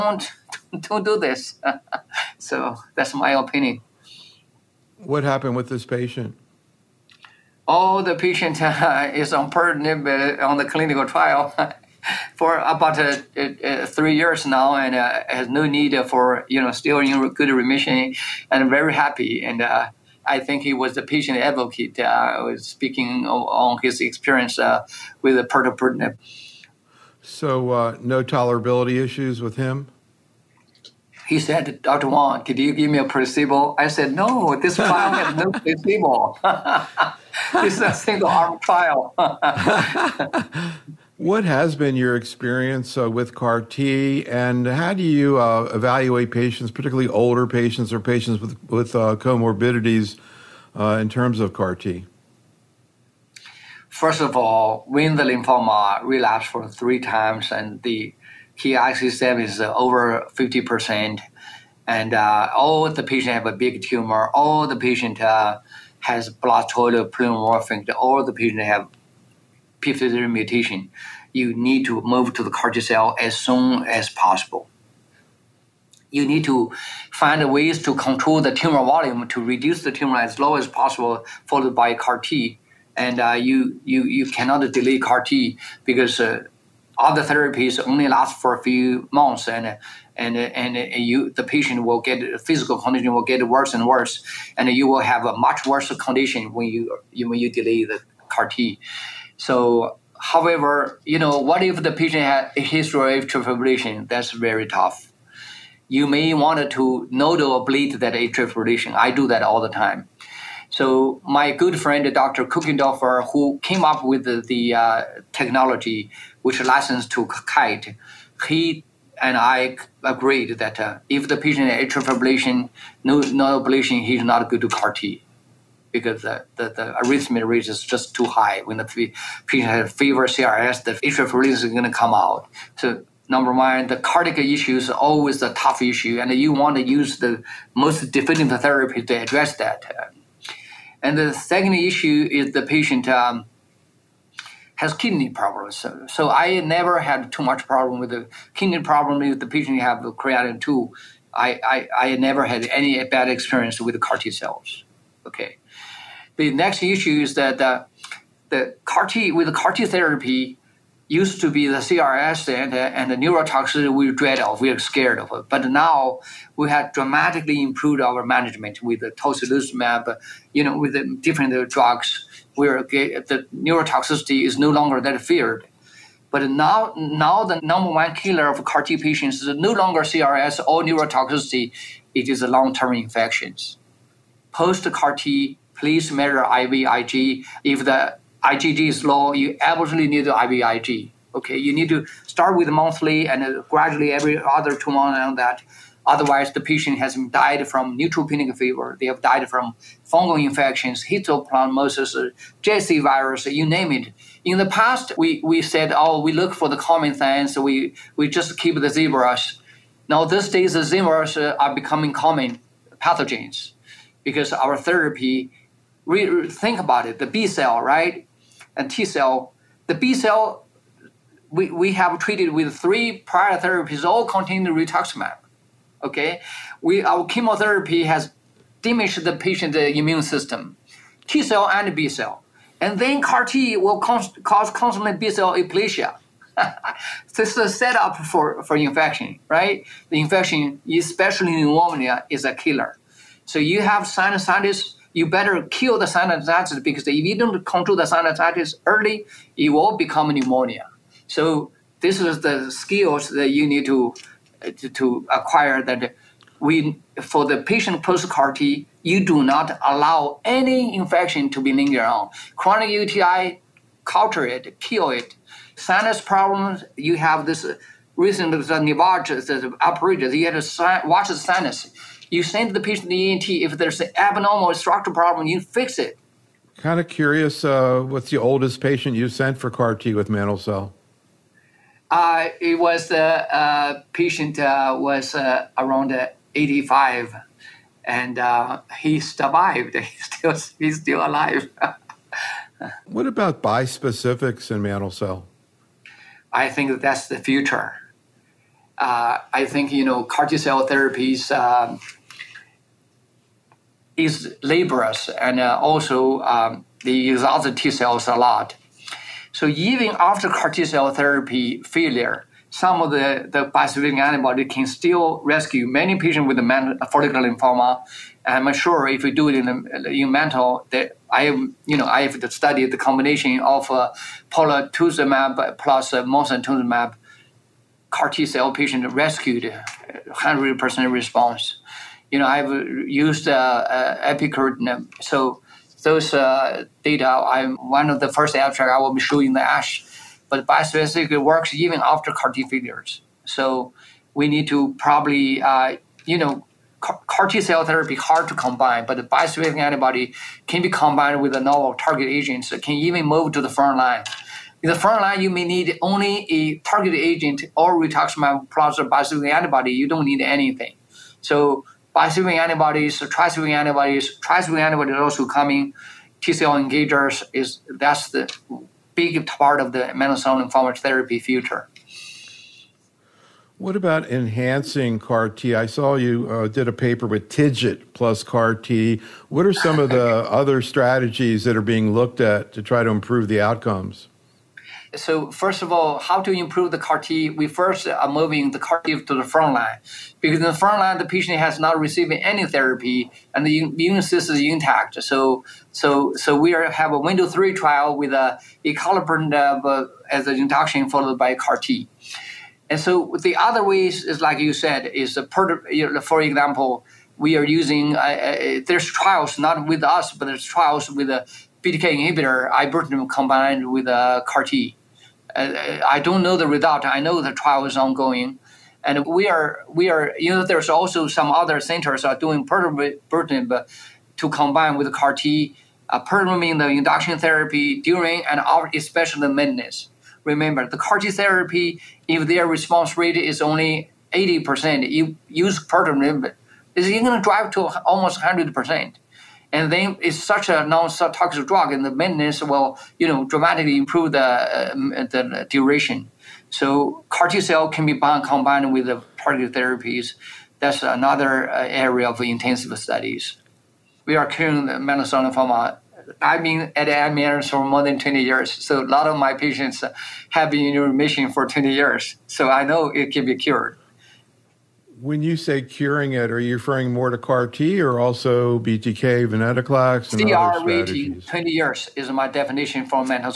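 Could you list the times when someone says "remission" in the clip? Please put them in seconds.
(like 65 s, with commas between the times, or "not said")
17 s, 460 s.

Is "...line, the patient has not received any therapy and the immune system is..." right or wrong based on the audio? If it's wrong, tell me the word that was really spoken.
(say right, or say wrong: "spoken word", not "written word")
right.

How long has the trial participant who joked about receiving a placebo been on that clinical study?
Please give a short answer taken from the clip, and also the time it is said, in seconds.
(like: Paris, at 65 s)
3 years, at 13 s.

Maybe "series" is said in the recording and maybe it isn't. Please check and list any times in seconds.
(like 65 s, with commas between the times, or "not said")
not said.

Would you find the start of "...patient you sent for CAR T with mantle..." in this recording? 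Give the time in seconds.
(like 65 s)
278 s.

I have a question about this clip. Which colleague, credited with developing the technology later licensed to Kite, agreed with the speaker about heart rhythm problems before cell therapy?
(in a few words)
Dr. Kochenderfer.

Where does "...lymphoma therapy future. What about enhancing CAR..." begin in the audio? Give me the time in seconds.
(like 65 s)
370 s.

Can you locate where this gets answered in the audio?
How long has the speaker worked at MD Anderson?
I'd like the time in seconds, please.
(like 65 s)
457 s.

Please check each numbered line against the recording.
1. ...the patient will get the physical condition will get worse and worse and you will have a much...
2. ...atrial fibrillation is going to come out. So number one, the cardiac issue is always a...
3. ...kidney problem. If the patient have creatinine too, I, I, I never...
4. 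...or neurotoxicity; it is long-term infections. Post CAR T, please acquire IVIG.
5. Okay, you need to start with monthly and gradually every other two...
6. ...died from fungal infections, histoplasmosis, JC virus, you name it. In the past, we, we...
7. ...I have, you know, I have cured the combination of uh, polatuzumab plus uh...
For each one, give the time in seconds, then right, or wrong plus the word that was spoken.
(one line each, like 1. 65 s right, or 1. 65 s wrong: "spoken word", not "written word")
1. 91 s right
2. 130 s right
3. 148 s right
4. 180 s wrong: "measure", not "acquire"
5. 191 s right
6. 199 s right
7. 321 s wrong: "studied", not "cured".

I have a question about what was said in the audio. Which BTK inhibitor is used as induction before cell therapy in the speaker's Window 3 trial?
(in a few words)
acalabrutinib.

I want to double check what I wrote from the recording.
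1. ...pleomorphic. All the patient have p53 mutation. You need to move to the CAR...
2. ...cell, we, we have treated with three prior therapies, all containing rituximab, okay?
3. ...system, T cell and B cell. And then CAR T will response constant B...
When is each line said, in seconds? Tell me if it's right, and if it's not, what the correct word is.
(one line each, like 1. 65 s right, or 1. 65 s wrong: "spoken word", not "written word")
1. 67 s right
2. 220 s right
3. 230 s wrong: "cause", not "response".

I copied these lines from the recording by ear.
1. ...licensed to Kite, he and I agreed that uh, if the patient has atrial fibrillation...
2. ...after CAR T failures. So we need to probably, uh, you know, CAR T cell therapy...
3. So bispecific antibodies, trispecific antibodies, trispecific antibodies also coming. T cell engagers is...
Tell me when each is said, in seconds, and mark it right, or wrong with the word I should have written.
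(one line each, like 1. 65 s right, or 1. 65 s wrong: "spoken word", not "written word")
1. 116 s right
2. 342 s right
3. 361 s right.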